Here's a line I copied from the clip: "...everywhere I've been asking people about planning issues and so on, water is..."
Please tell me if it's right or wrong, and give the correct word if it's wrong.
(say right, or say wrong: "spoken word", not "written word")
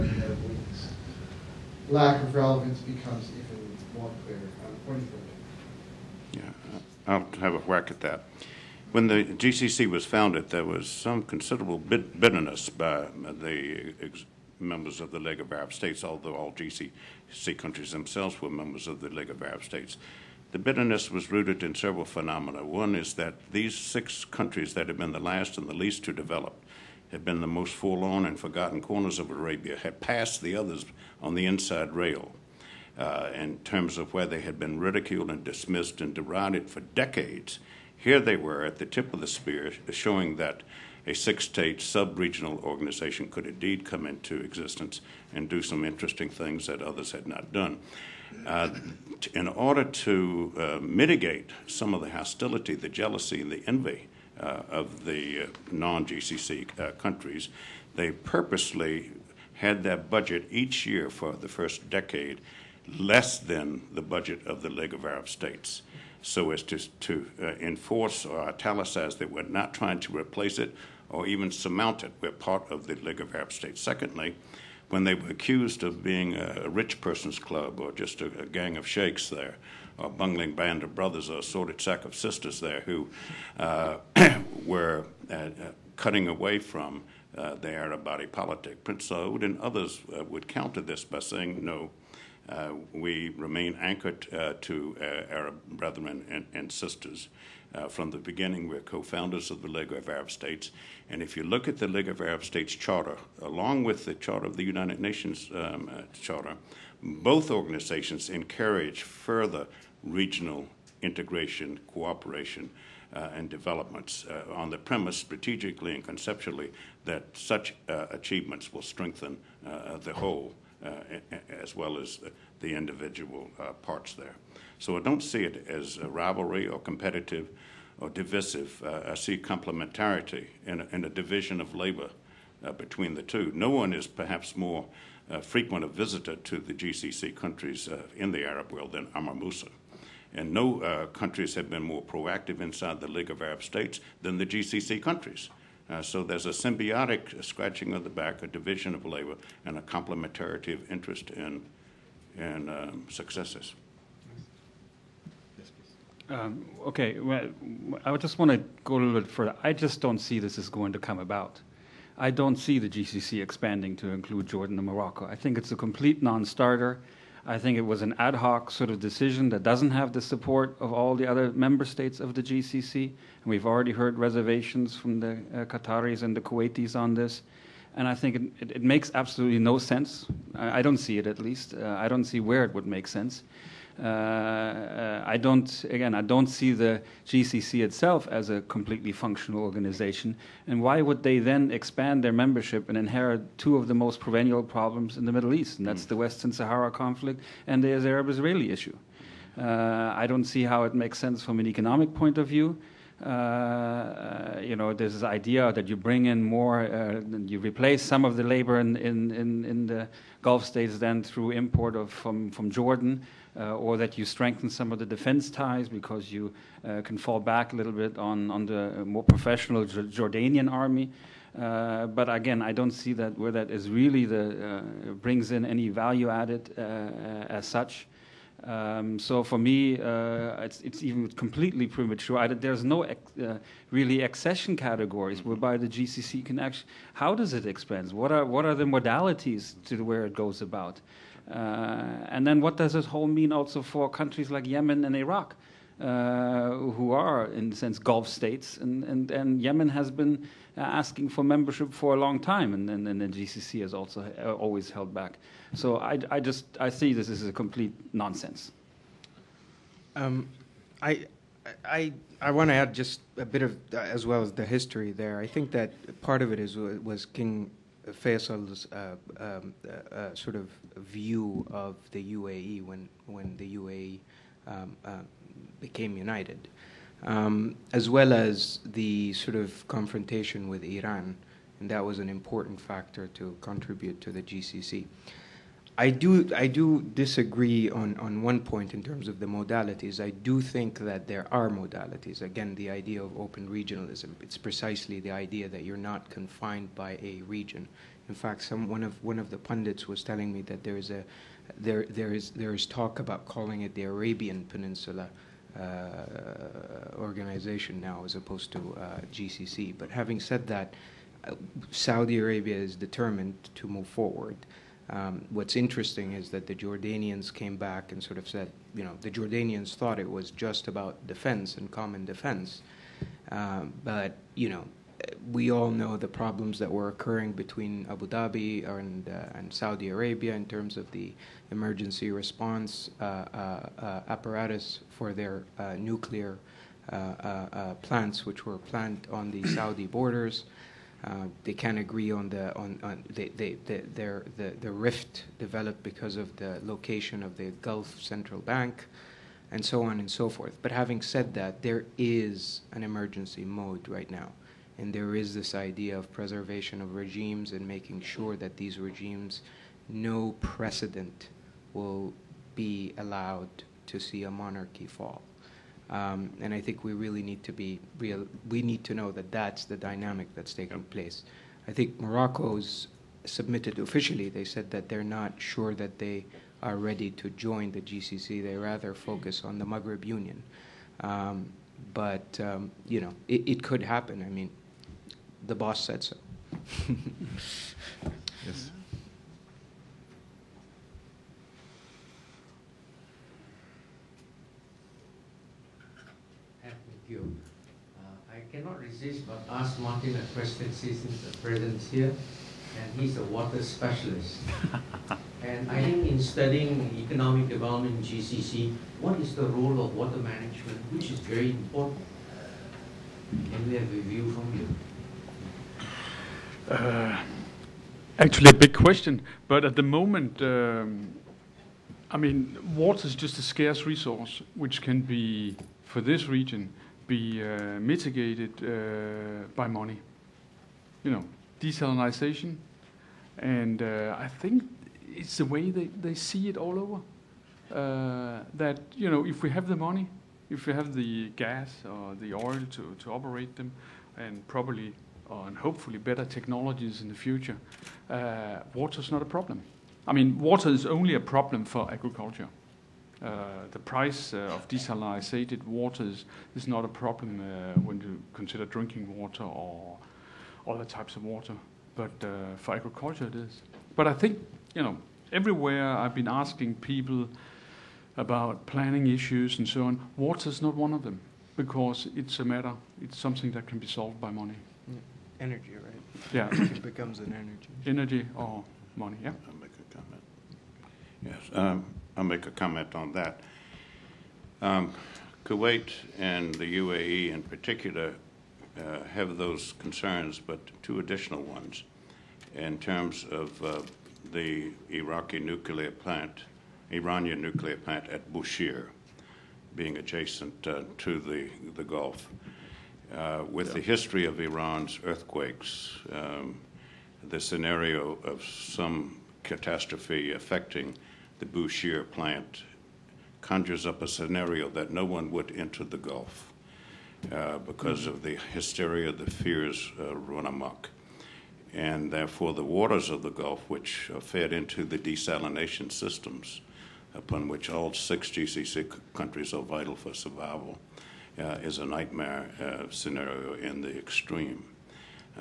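right.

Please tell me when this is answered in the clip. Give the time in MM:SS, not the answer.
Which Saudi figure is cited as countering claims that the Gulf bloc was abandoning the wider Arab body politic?
01:28.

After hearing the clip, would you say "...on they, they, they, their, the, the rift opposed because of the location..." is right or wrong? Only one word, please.
wrong.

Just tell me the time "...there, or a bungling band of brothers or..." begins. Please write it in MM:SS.
01:19.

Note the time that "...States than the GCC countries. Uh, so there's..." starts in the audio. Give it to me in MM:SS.
02:23.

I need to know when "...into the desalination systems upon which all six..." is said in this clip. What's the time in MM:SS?
08:44.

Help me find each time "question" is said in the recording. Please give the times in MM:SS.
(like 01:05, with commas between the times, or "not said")
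06:40, 06:58.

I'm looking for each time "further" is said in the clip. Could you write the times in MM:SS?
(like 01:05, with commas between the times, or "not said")
01:49, 02:39.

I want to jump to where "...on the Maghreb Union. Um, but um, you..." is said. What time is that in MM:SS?
06:19.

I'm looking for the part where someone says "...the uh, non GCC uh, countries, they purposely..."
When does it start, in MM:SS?
00:55.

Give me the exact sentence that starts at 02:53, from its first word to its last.
And we've already heard reservations from the uh, Qataris and the Kuwaitis on this.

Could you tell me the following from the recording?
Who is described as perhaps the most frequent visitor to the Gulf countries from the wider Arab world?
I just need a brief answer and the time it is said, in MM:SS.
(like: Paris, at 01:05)
Amr Musa, at 02:19.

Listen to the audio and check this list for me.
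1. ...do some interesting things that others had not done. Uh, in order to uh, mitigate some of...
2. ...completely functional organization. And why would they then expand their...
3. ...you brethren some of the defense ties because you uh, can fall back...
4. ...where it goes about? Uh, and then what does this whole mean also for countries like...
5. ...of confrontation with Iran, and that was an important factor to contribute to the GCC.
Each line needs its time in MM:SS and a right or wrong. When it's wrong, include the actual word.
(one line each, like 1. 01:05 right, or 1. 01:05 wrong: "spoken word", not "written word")
1. 00:45 right
2. 03:08 right
3. 03:34 wrong: "strengthen", not "brethren"
4. 04:00 right
5. 04:39 right.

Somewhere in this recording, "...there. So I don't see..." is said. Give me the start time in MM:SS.
02:04.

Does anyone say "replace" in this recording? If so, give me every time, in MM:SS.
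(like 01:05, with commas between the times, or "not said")
01:10, 03:27.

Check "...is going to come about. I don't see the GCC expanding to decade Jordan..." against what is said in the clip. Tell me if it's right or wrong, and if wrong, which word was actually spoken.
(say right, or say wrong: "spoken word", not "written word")
wrong: "include", not "decade".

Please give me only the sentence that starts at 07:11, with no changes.
You know, desalinization, and uh, I think it's the way they, they see it all over.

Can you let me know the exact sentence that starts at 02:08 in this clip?
Uh, I see complementarity and, and a division of labor between the two.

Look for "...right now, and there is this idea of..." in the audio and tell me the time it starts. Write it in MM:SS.
05:54.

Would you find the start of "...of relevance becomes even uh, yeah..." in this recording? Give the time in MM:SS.
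00:02.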